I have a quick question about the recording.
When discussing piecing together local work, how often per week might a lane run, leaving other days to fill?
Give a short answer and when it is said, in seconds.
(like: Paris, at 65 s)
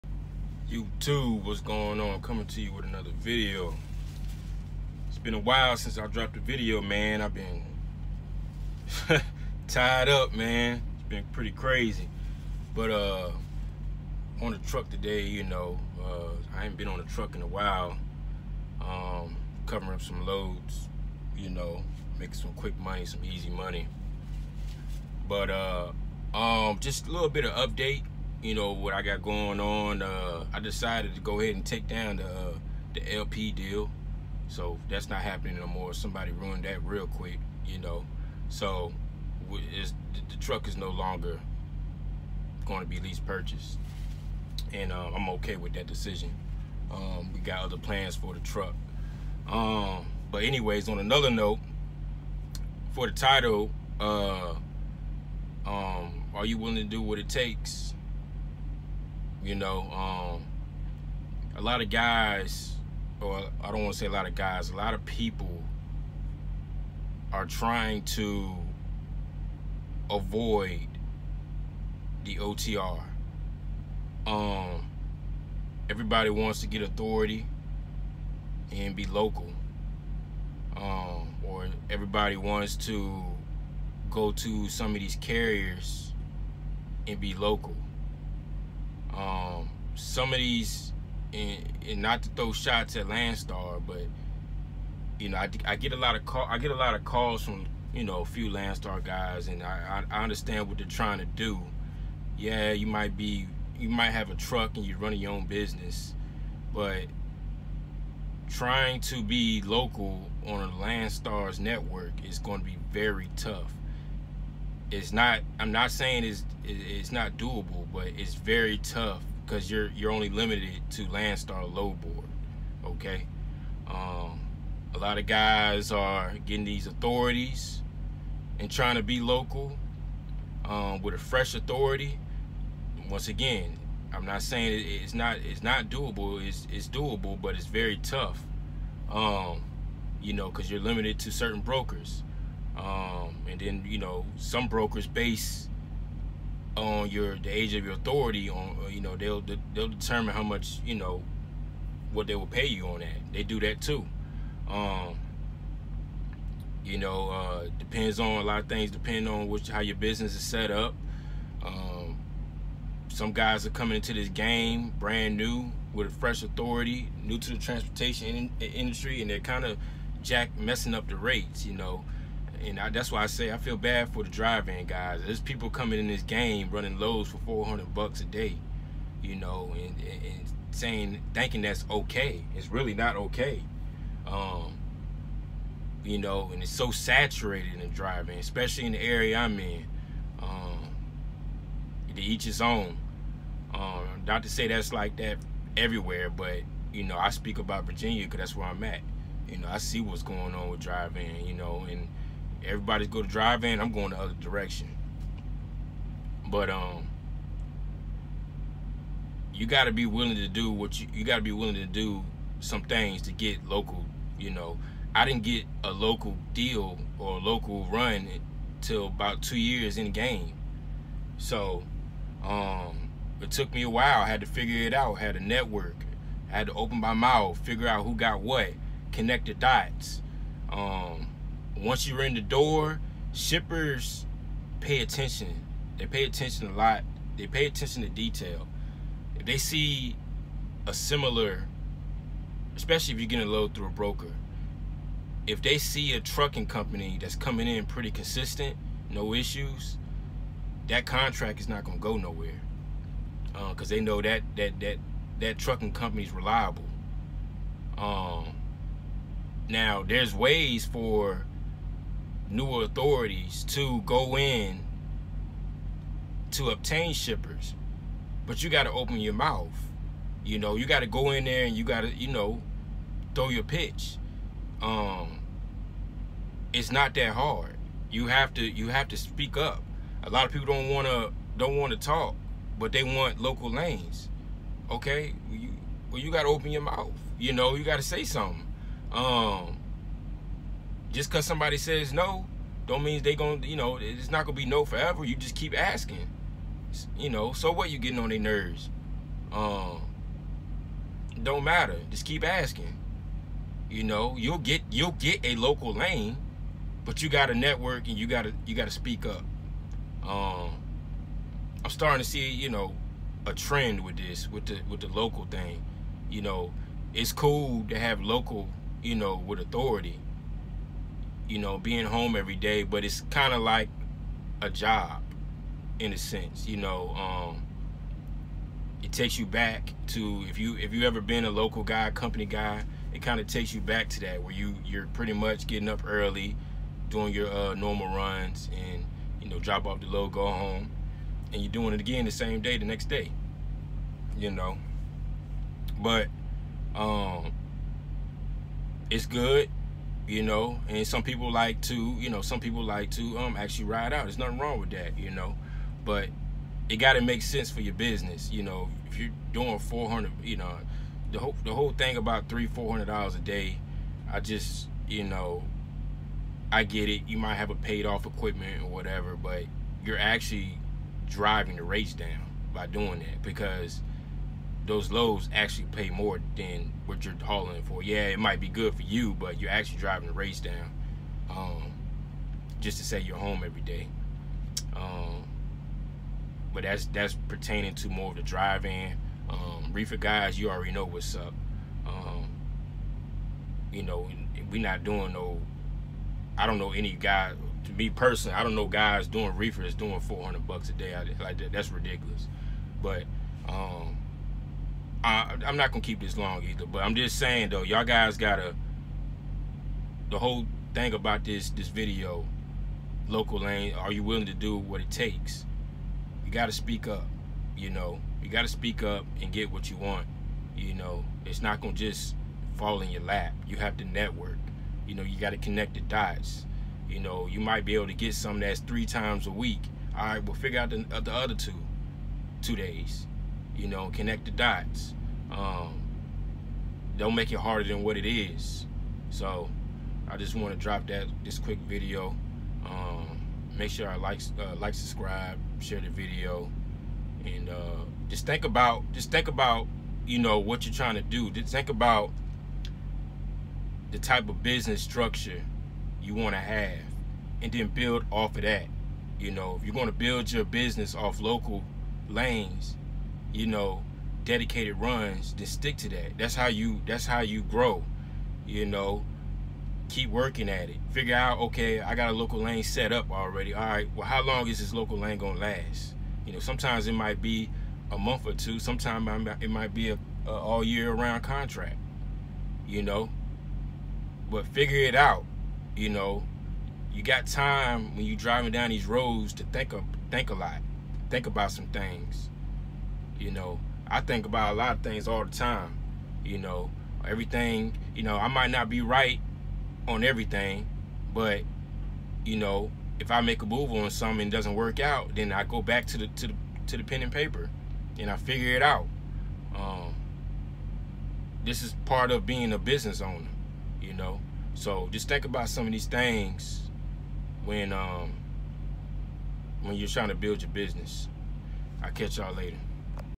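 3 times a week, at 428 s.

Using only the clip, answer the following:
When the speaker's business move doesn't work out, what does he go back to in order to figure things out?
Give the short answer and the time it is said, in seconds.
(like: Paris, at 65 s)
Pen and paper, at 507 s.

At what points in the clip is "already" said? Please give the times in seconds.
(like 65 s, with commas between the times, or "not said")
390 s, 473 s.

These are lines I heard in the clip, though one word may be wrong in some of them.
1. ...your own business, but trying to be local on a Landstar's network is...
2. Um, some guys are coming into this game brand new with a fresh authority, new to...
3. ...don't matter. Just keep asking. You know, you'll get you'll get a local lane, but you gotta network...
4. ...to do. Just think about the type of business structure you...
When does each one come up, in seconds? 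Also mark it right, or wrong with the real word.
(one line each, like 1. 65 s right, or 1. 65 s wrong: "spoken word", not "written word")
1. 105 s right
2. 161 s right
3. 301 s right
4. 451 s right.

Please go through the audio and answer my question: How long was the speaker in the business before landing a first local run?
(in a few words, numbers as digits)
2 years.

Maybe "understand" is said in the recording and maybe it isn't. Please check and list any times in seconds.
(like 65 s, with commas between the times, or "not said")
100 s.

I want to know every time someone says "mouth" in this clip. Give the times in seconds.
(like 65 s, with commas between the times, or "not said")
227 s, 269 s, 286 s.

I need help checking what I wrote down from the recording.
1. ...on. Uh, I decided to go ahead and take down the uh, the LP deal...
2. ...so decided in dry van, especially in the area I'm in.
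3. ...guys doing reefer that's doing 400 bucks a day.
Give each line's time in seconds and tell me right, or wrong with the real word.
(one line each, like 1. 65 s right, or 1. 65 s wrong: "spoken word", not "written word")
1. 29 s right
2. 186 s wrong: "saturated", not "decided"
3. 398 s right.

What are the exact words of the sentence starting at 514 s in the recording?
So just think about some of these things when um, when you're trying to build your business.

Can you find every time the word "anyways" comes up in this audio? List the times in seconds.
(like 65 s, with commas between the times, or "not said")
50 s.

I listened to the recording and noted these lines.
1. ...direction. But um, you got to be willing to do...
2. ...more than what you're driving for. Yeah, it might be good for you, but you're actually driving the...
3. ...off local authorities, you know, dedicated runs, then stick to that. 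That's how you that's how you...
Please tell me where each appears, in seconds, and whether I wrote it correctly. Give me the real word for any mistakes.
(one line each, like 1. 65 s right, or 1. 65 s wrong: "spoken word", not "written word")
1. 204 s right
2. 376 s wrong: "hauling", not "driving"
3. 461 s wrong: "lanes", not "authorities".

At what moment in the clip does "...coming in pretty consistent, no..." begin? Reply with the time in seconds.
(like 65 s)
247 s.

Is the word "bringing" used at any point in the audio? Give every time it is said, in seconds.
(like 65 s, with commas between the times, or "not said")
not said.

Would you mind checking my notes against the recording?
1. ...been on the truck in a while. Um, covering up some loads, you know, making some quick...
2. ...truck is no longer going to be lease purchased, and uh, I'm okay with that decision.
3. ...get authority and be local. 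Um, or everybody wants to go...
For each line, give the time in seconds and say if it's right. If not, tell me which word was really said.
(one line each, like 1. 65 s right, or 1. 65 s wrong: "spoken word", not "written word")
1. 16 s right
2. 40 s right
3. 76 s right.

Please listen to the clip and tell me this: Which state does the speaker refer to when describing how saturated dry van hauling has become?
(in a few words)
Virginia.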